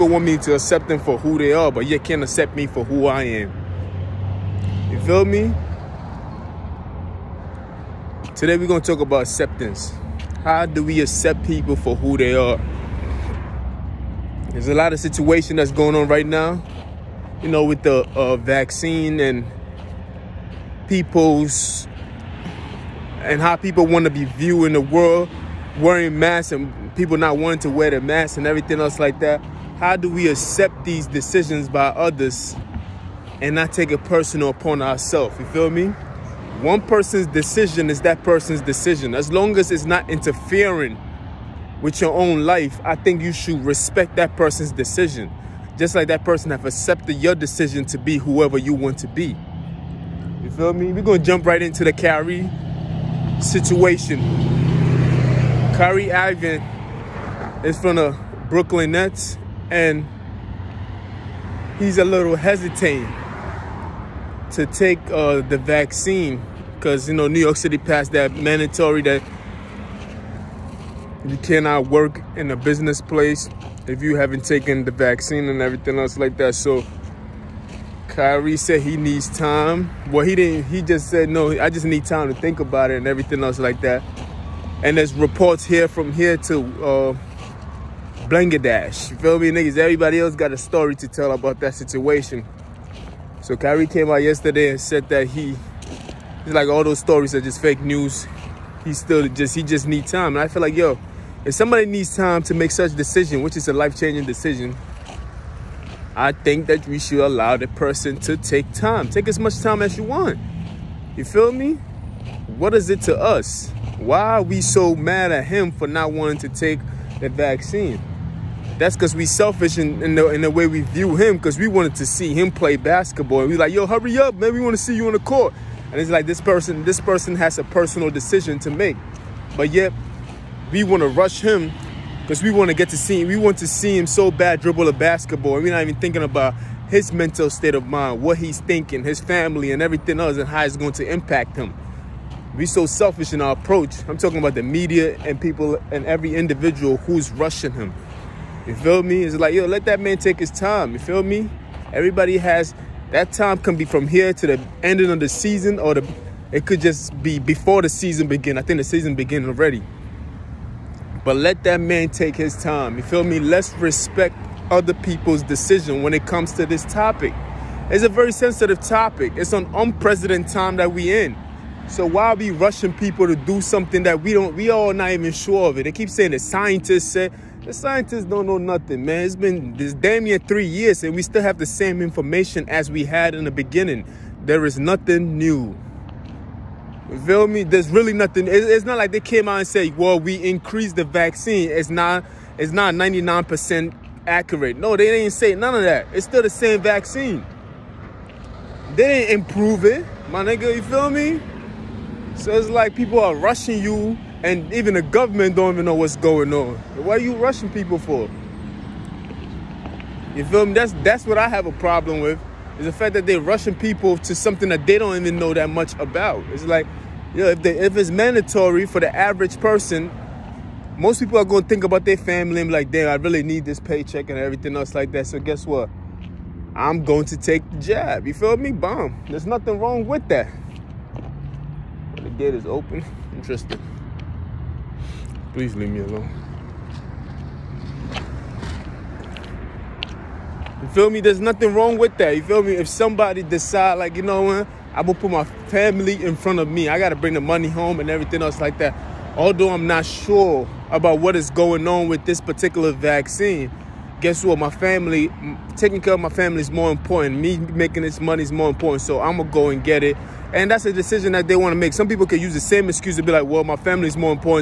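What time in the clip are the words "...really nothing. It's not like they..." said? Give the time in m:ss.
3:07.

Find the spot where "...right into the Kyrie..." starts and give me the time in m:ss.
0:51.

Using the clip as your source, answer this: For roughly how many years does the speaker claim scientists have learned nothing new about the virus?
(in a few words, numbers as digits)
3.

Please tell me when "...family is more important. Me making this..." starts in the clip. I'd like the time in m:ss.
4:16.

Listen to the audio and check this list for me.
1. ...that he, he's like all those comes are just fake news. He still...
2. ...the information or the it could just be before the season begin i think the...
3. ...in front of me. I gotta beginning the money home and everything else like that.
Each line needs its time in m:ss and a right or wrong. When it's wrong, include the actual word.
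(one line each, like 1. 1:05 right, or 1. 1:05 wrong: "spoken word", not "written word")
1. 1:35 wrong: "stories", not "comes"
2. 2:35 wrong: "season", not "information"
3. 4:06 wrong: "bring", not "beginning".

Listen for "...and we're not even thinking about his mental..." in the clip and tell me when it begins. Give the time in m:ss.
2:15.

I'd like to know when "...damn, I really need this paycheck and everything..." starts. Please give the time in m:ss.
3:42.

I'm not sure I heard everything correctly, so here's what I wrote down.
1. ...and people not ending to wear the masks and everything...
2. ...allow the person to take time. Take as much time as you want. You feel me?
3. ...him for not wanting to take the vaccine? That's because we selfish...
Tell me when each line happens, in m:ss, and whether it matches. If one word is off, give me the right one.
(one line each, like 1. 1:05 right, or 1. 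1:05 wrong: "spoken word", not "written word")
1. 0:26 wrong: "wanting", not "ending"
2. 1:47 right
3. 1:55 right.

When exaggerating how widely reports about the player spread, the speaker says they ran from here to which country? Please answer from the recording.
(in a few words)
Bangladesh.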